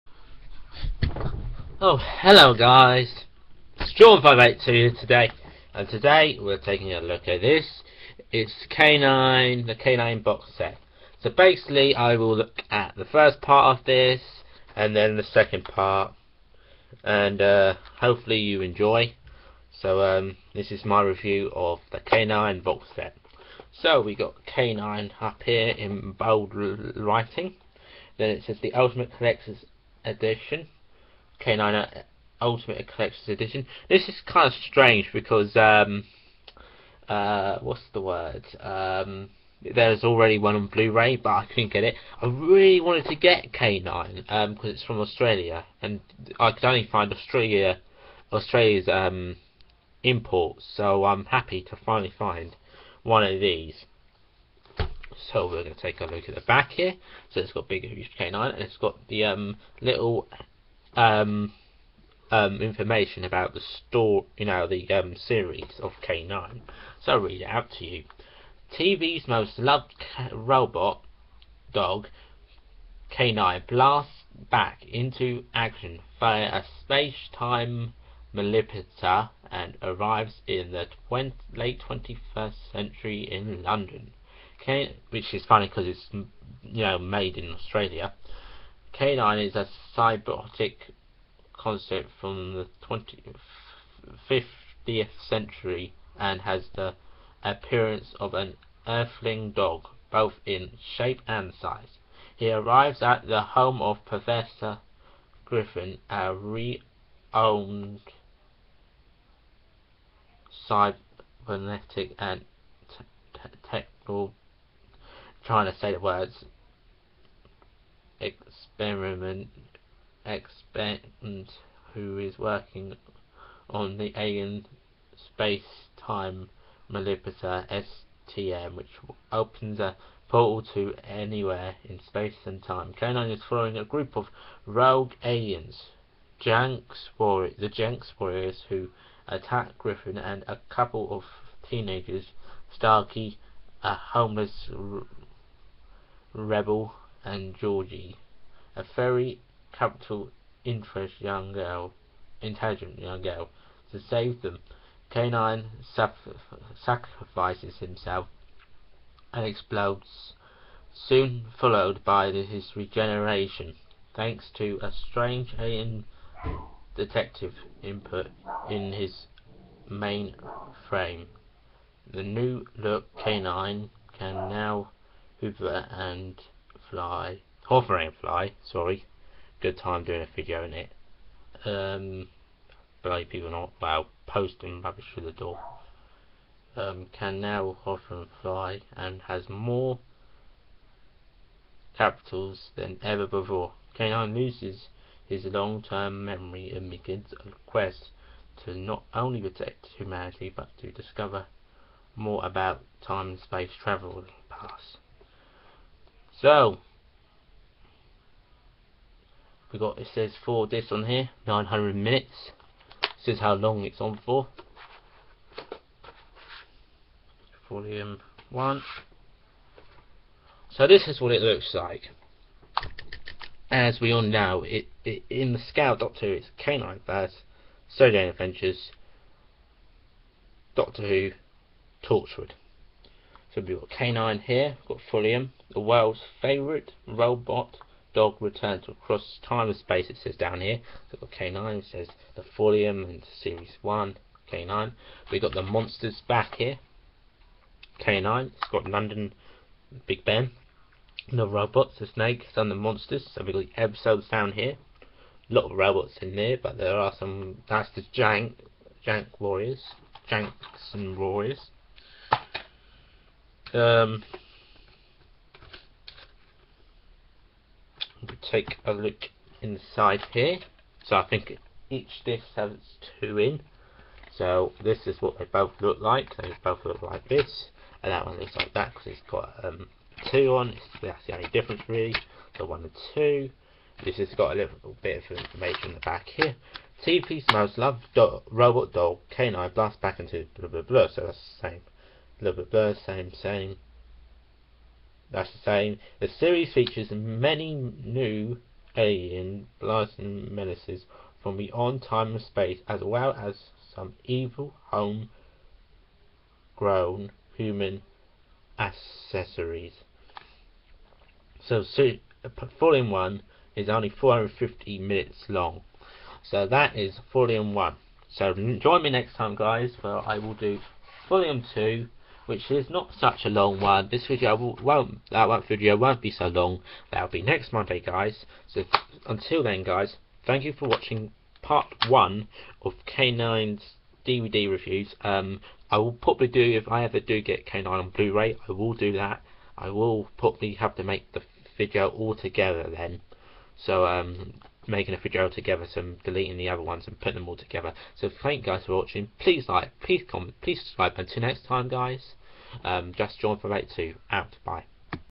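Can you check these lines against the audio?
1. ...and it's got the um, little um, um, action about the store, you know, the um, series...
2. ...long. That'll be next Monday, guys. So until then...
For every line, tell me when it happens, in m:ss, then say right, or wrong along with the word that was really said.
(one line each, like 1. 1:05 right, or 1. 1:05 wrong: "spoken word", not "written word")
1. 0:58 wrong: "information", not "action"
2. 5:26 right.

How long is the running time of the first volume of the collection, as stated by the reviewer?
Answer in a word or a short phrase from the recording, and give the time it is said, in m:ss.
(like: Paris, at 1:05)
450 minutes, at 5:14.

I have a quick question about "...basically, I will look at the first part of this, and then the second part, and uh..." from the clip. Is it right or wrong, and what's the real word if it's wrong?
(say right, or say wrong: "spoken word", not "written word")
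right.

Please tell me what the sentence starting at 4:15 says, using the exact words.
A lot of robots in there, but there are some, that's the Jank, Jank Warriors, Janks and Warriors.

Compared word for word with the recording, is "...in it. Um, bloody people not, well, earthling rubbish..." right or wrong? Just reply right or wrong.
wrong.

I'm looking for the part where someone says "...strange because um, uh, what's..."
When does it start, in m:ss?
0:34.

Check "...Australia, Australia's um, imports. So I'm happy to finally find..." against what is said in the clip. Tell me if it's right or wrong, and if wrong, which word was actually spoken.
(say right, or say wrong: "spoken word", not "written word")
right.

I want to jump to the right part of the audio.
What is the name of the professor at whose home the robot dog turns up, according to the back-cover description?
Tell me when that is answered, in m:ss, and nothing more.
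1:44.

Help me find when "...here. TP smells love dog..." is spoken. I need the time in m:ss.
4:46.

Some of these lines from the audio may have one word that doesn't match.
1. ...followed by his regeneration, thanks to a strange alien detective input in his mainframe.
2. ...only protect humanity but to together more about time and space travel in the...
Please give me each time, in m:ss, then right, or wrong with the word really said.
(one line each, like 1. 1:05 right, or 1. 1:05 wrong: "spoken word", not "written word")
1. 2:41 right
2. 3:19 wrong: "discover", not "together".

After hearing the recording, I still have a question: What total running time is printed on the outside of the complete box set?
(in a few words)
900 minutes.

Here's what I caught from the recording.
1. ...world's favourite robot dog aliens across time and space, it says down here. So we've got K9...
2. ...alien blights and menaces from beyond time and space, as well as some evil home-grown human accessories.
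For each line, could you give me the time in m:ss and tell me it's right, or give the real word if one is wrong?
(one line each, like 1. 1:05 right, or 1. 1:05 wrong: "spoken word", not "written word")
1. 3:55 wrong: "returns", not "aliens"
2. 4:58 right.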